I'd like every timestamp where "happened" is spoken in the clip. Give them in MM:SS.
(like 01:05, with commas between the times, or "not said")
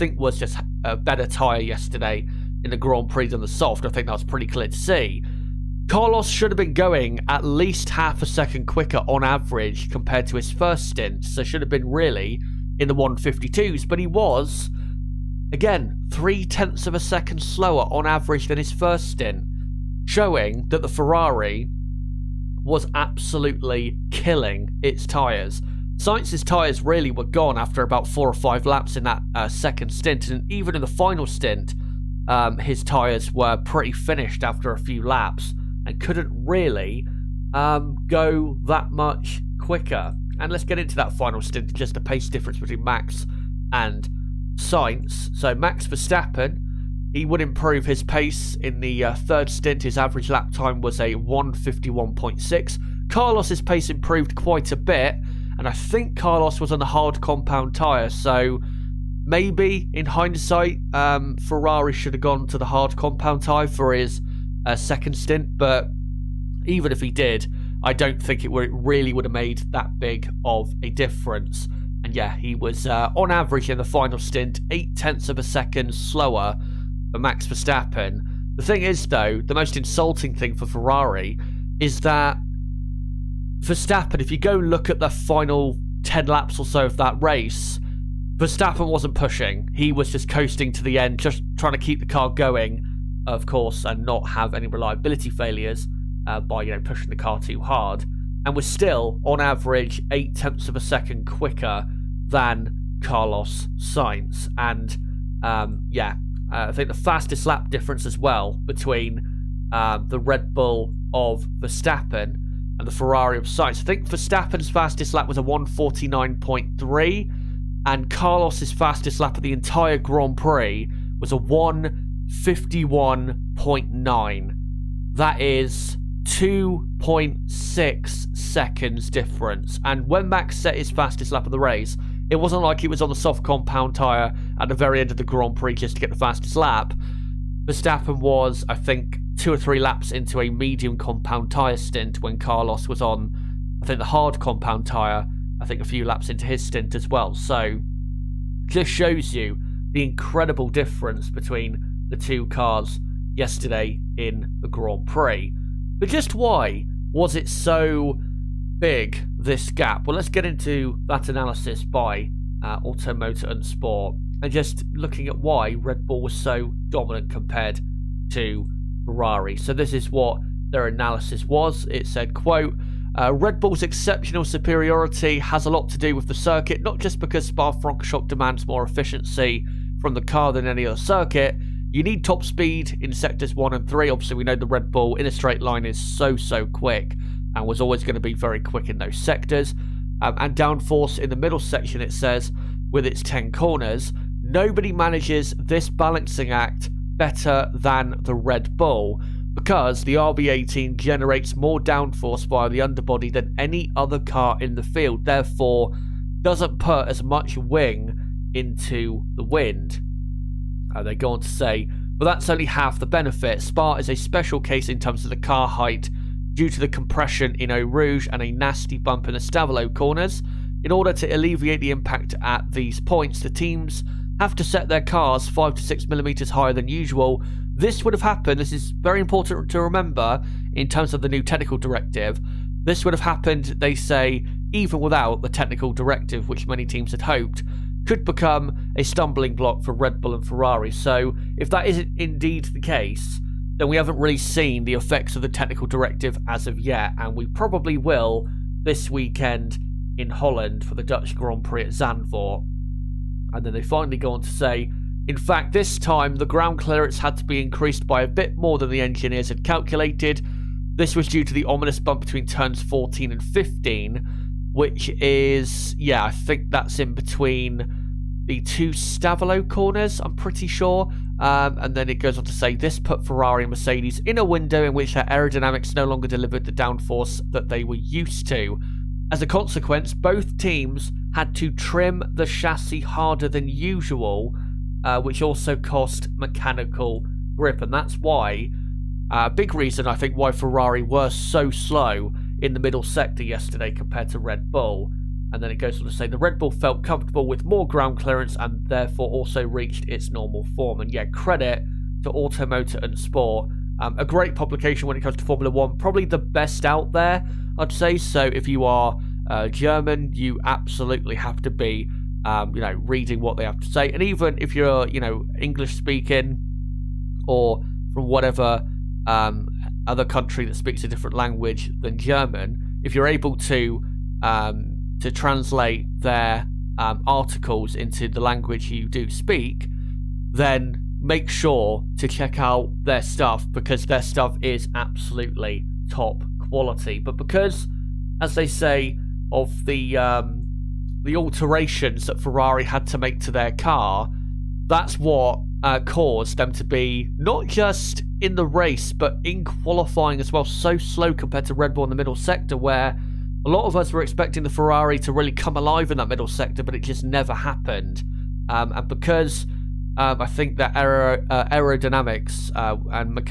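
03:48, 03:53, 05:57.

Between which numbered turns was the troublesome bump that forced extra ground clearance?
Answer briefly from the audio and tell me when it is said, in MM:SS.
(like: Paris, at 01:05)
Turns 14 and 15, at 04:22.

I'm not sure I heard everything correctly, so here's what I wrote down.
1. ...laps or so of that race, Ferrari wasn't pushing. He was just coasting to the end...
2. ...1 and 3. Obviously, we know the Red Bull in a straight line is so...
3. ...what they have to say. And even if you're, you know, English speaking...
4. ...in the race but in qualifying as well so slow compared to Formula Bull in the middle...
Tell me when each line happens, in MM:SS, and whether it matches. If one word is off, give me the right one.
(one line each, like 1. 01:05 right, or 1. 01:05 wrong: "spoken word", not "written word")
1. 01:26 wrong: "Verstappen", not "Ferrari"
2. 03:03 right
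3. 05:13 right
4. 05:48 wrong: "Red", not "Formula".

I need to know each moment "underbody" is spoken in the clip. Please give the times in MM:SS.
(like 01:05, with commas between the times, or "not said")
03:22.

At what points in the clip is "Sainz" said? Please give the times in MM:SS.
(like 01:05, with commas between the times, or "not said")
00:25, 01:43, 01:53.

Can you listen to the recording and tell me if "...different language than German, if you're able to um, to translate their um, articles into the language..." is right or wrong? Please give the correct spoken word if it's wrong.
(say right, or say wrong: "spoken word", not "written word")
right.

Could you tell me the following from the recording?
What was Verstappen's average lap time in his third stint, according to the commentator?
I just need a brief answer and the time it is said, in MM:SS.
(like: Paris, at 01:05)
1:51.6, at 00:51.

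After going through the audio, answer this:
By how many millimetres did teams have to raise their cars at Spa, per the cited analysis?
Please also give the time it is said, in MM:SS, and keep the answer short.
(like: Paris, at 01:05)
5 to 6 millimetres, at 03:45.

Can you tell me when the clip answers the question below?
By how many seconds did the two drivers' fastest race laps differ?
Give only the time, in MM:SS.
02:06.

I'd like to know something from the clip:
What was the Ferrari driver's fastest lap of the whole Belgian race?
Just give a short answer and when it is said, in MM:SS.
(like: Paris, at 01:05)
1:51.9, at 02:01.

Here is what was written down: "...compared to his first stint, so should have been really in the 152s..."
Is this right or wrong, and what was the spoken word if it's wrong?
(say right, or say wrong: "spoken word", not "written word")
right.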